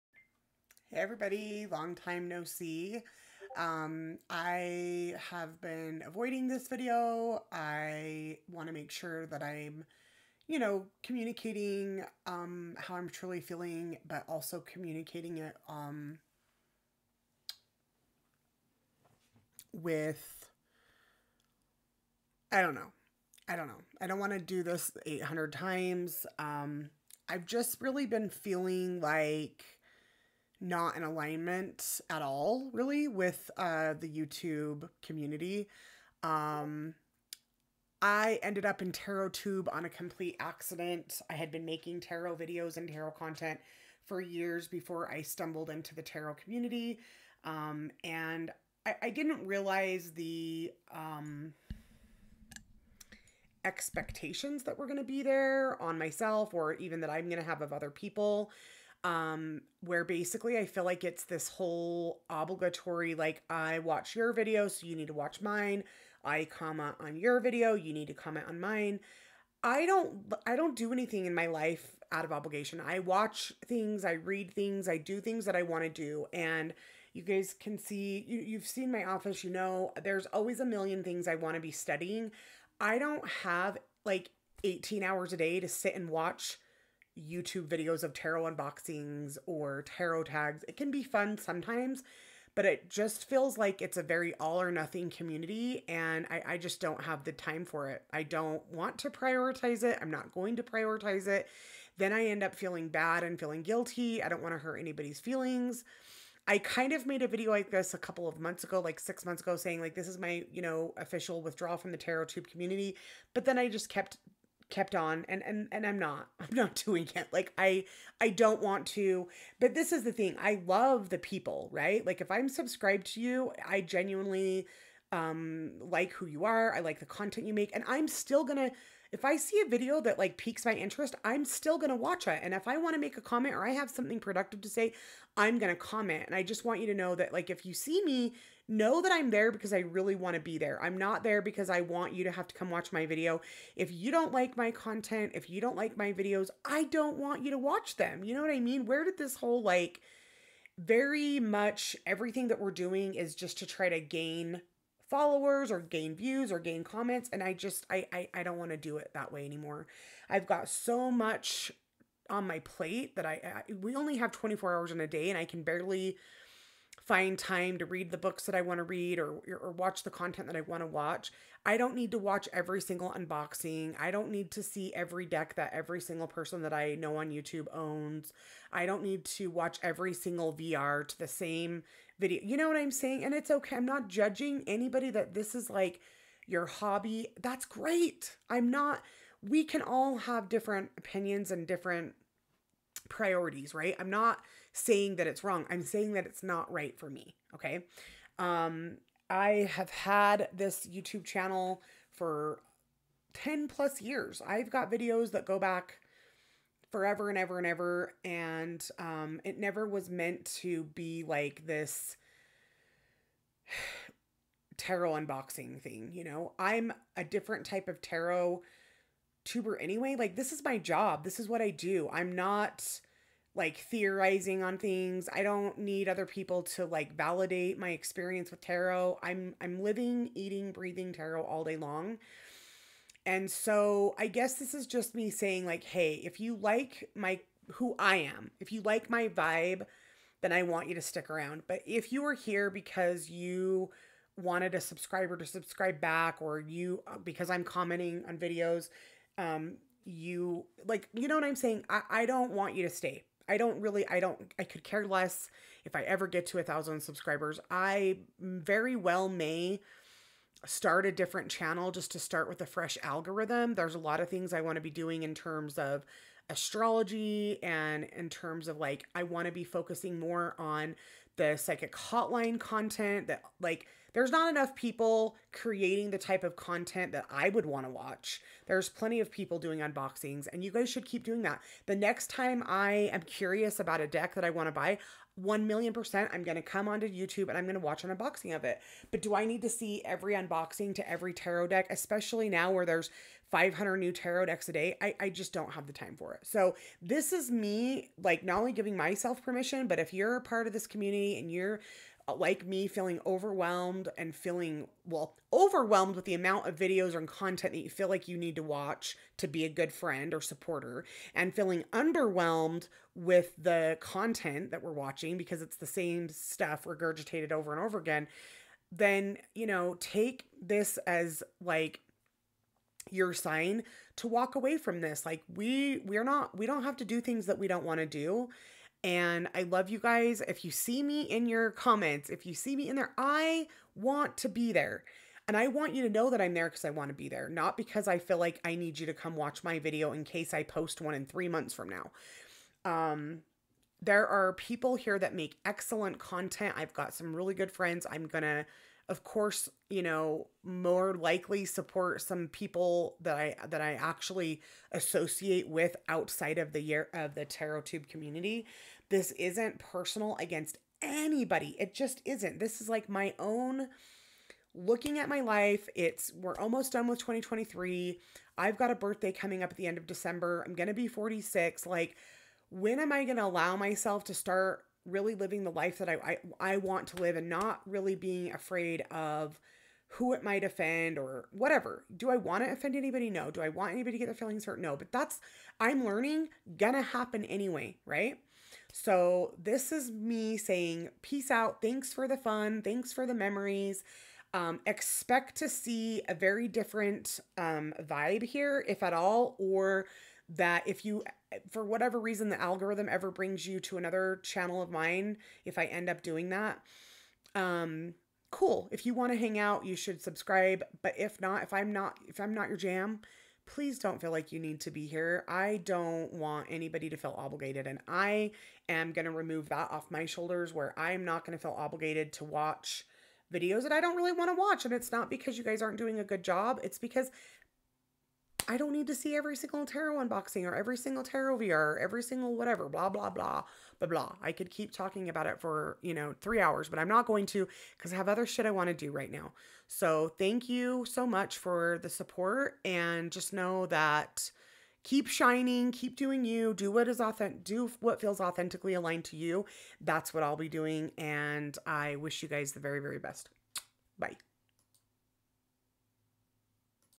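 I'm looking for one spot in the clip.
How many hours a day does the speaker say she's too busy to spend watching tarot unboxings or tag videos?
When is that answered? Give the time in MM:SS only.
01:24.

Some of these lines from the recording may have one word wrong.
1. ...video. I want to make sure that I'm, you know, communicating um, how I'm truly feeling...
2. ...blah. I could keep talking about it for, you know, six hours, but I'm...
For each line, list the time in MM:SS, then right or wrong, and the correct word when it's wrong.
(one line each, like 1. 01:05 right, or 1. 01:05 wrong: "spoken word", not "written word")
1. 00:06 right
2. 07:14 wrong: "three", not "six".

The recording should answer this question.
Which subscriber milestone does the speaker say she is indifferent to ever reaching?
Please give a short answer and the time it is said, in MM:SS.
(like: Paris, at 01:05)
1,000 subscribers, at 04:16.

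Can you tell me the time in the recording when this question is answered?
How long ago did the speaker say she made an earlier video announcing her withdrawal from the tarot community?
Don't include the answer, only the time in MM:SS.
01:48.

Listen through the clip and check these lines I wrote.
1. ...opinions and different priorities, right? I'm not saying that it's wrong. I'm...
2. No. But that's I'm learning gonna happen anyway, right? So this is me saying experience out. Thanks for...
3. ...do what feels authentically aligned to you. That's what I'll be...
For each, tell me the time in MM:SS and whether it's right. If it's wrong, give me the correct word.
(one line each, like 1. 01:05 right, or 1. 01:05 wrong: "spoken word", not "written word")
1. 03:10 right
2. 06:24 wrong: "peace", not "experience"
3. 07:27 right.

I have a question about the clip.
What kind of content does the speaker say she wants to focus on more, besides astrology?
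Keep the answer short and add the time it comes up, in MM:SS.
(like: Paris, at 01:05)
psychic hotline content, at 04:31.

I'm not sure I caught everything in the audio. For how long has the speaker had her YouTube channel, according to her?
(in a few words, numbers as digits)
10 plus years.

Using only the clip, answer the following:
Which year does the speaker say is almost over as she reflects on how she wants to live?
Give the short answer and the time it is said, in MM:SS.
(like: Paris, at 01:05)
2023, at 06:07.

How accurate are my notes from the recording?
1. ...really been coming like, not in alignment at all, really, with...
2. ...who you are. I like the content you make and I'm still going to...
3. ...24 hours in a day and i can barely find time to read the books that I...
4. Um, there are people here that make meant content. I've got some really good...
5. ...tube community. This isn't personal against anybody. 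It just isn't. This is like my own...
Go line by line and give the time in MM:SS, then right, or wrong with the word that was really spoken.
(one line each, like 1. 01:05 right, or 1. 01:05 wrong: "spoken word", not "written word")
1. 00:27 wrong: "feeling", not "coming"
2. 02:06 right
3. 02:44 right
4. 05:42 wrong: "excellent", not "meant"
5. 05:57 right.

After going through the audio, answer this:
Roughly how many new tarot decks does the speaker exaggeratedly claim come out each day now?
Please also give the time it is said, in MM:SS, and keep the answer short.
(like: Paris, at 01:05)
500, at 04:53.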